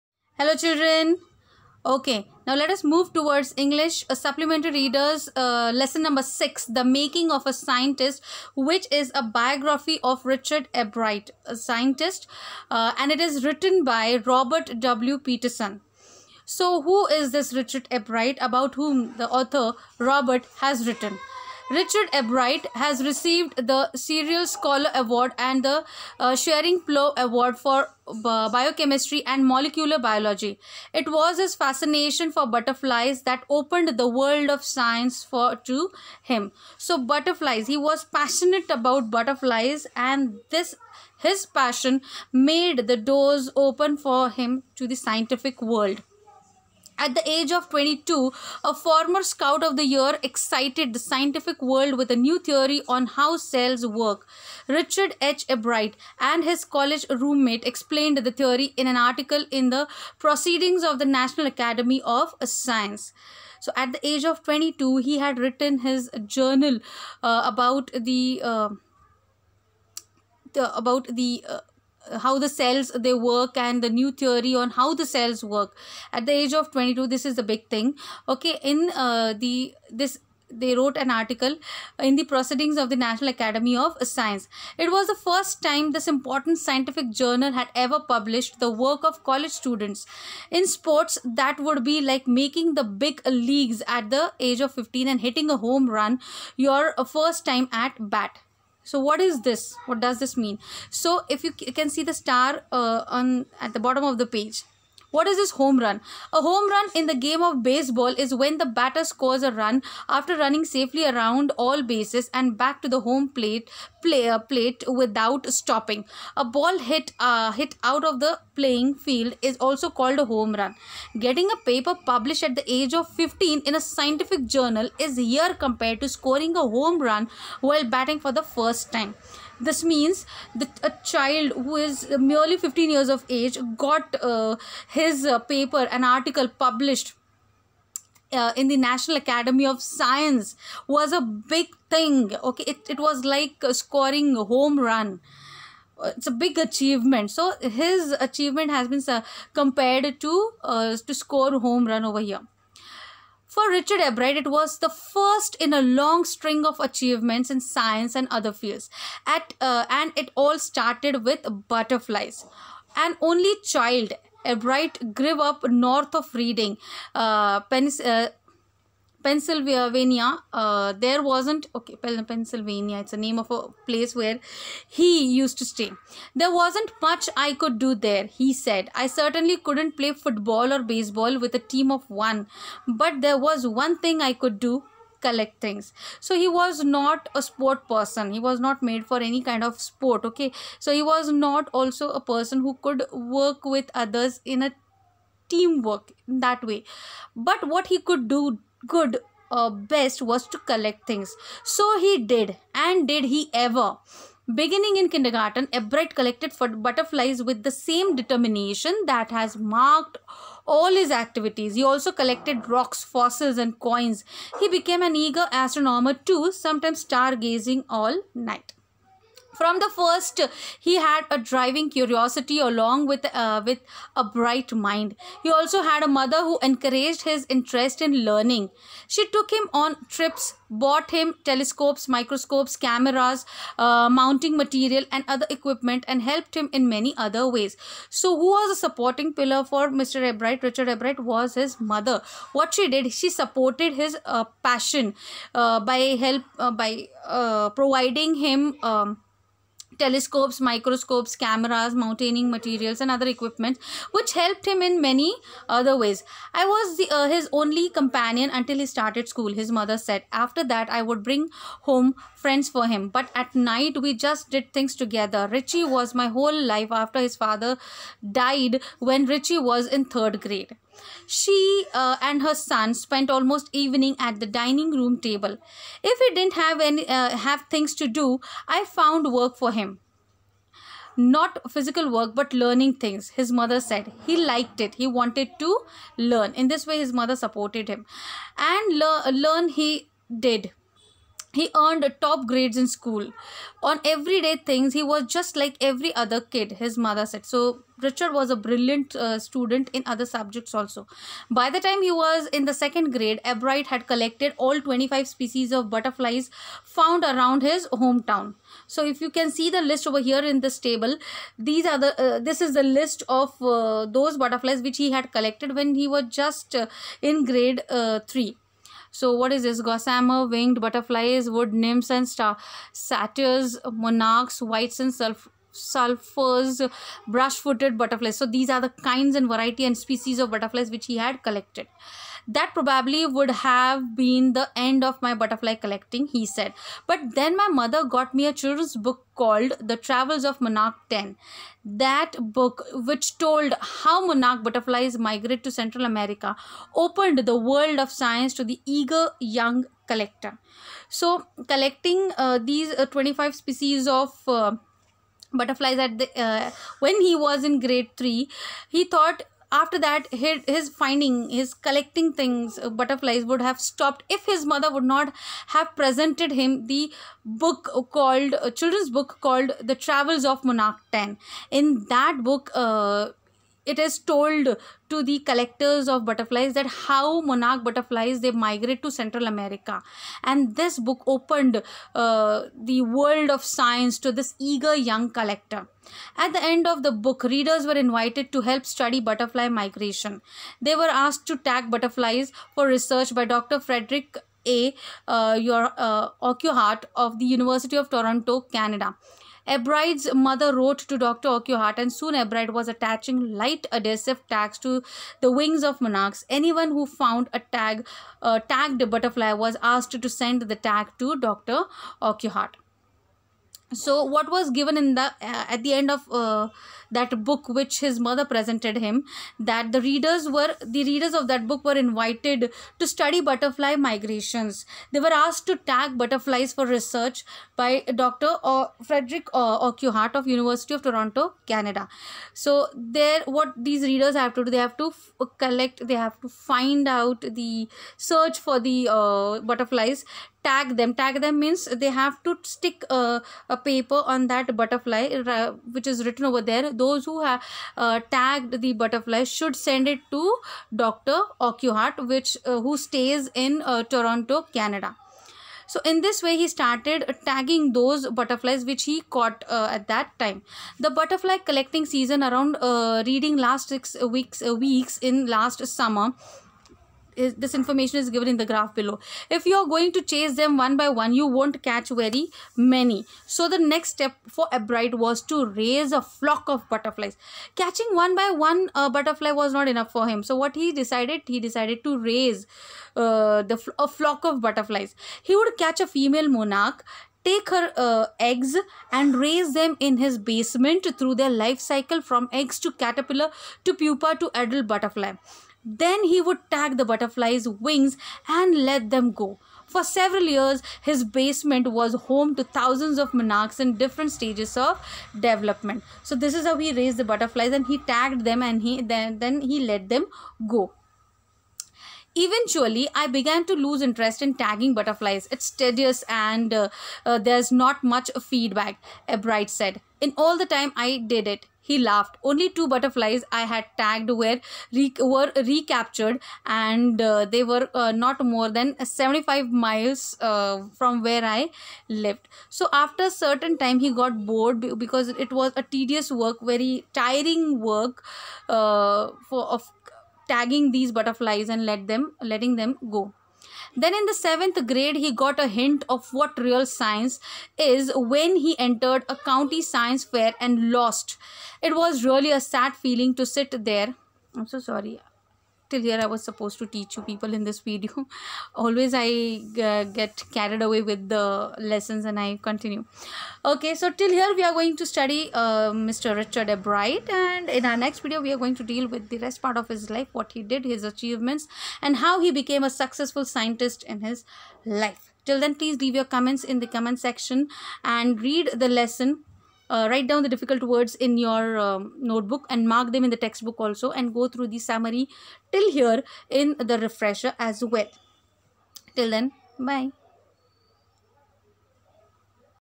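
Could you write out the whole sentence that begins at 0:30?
It was his fascination for butterflies that opened the world of science for to him.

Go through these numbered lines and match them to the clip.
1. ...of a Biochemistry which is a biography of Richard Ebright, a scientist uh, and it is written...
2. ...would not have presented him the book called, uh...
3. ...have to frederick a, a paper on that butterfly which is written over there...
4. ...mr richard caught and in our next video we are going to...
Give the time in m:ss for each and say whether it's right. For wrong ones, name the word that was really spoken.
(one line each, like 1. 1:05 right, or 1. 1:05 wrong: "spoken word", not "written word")
1. 0:07 wrong: "Scientist", not "Biochemistry"
2. 6:04 right
3. 7:22 wrong: "stick", not "frederick"
4. 9:26 wrong: "bright", not "caught".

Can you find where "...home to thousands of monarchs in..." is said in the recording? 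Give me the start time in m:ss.
8:22.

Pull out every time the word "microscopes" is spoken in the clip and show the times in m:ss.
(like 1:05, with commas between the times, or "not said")
3:52, 4:10.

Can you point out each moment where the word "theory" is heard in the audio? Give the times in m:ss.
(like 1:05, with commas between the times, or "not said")
0:52, 0:58, 1:14.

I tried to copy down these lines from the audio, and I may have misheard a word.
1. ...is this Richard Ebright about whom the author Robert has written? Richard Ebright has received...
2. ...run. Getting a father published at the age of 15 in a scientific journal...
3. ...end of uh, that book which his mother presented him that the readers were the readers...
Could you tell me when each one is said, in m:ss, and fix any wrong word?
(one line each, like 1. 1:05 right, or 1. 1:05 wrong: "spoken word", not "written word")
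1. 0:17 right
2. 2:00 wrong: "paper", not "father"
3. 6:55 right.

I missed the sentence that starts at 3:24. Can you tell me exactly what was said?
Beginning in kindergarten, Ebright collected for butterflies with the same determination that has marked all his activities.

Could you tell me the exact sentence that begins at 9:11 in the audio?
It was really a sad feeling to sit there.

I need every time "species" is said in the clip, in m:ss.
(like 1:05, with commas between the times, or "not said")
5:05, 5:29, 5:53.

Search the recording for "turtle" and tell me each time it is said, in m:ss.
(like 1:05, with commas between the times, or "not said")
not said.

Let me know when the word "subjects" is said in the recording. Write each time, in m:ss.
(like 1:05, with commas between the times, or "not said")
5:00.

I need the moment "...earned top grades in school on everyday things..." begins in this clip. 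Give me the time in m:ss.
4:51.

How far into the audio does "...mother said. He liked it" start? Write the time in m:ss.
4:43.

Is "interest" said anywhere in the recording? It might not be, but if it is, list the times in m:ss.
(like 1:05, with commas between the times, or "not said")
3:47, 8:34.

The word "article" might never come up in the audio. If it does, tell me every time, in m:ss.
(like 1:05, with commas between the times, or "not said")
0:58, 1:21, 2:16.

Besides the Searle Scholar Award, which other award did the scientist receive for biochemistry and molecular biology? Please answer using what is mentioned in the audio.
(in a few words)
Schering Plough Award.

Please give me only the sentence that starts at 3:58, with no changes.
So, who was a supporting pillar for Mr.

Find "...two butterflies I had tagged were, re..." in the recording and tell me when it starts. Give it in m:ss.
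8:42.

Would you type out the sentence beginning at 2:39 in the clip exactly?
At uh, and it all started with butterflies.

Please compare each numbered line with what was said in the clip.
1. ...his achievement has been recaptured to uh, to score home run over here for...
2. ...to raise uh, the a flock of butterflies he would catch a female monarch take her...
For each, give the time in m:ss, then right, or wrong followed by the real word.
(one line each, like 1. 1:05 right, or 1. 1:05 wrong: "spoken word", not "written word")
1. 2:27 wrong: "compared", not "recaptured"
2. 8:02 right.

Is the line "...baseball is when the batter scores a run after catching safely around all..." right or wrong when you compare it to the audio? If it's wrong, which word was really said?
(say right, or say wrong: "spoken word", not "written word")
wrong: "running", not "catching".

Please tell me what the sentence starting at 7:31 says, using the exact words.
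Urquhart, which uh, who stays in uh, Toronto, Canada.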